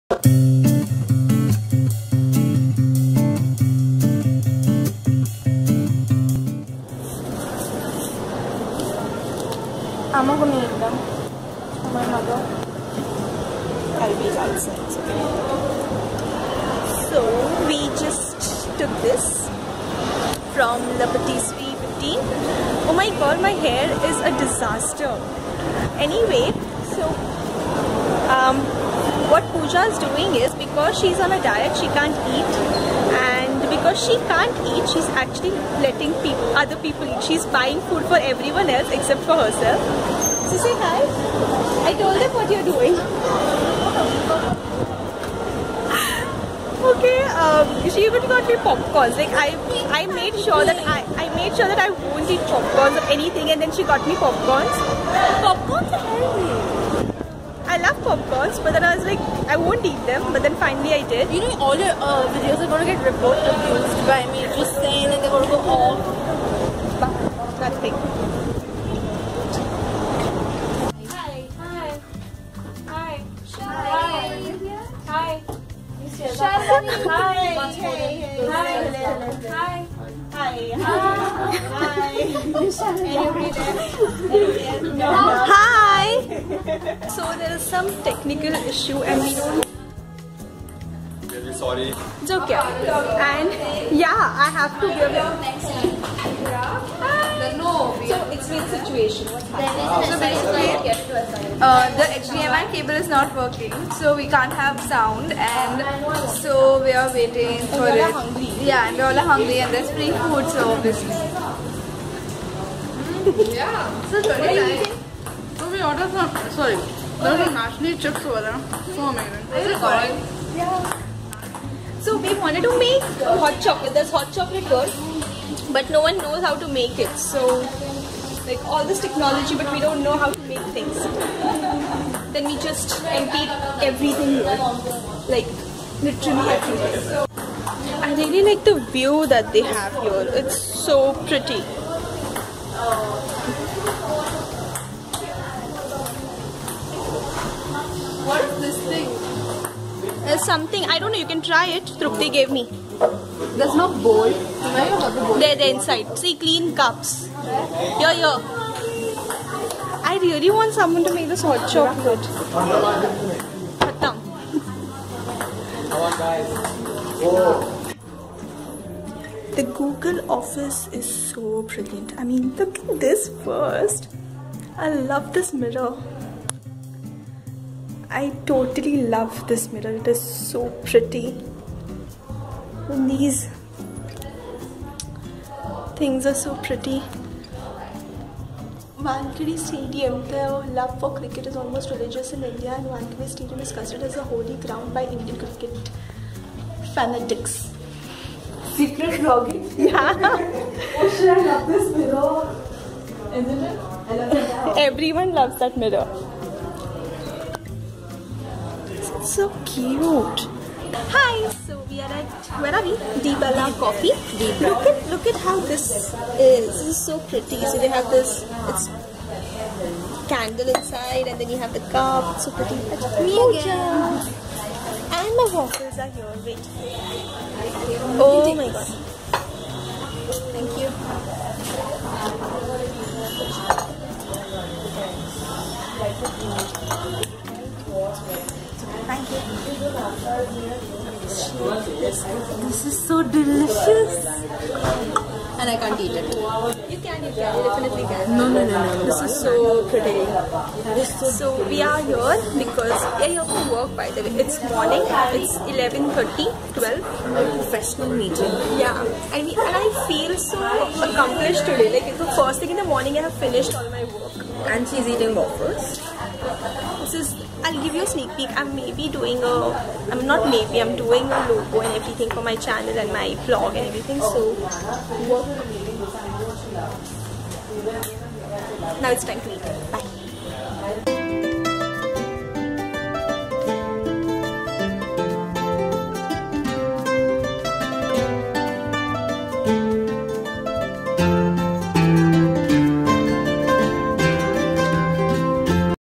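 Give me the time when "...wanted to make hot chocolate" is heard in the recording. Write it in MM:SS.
02:02.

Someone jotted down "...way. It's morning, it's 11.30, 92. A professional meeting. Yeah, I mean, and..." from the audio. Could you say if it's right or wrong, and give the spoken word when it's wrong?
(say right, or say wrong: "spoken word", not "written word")
wrong: "12", not "92".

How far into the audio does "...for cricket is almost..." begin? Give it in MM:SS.
03:10.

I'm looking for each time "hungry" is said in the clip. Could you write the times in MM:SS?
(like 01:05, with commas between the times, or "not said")
01:49.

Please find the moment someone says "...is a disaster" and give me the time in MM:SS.
00:23.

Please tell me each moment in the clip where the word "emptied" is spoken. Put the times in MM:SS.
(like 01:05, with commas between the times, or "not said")
02:13.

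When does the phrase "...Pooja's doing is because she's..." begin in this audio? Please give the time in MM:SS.
00:29.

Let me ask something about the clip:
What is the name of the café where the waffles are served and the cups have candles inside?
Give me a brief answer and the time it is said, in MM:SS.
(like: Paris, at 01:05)
Di Bella Coffee, at 03:33.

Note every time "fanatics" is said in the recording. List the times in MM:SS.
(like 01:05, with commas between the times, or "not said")
03:16.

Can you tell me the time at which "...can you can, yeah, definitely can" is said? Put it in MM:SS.
04:06.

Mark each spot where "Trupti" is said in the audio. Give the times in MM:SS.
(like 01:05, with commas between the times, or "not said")
02:31.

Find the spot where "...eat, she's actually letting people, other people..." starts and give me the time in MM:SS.
00:34.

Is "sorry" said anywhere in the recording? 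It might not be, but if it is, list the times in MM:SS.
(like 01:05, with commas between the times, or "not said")
01:31, 01:56.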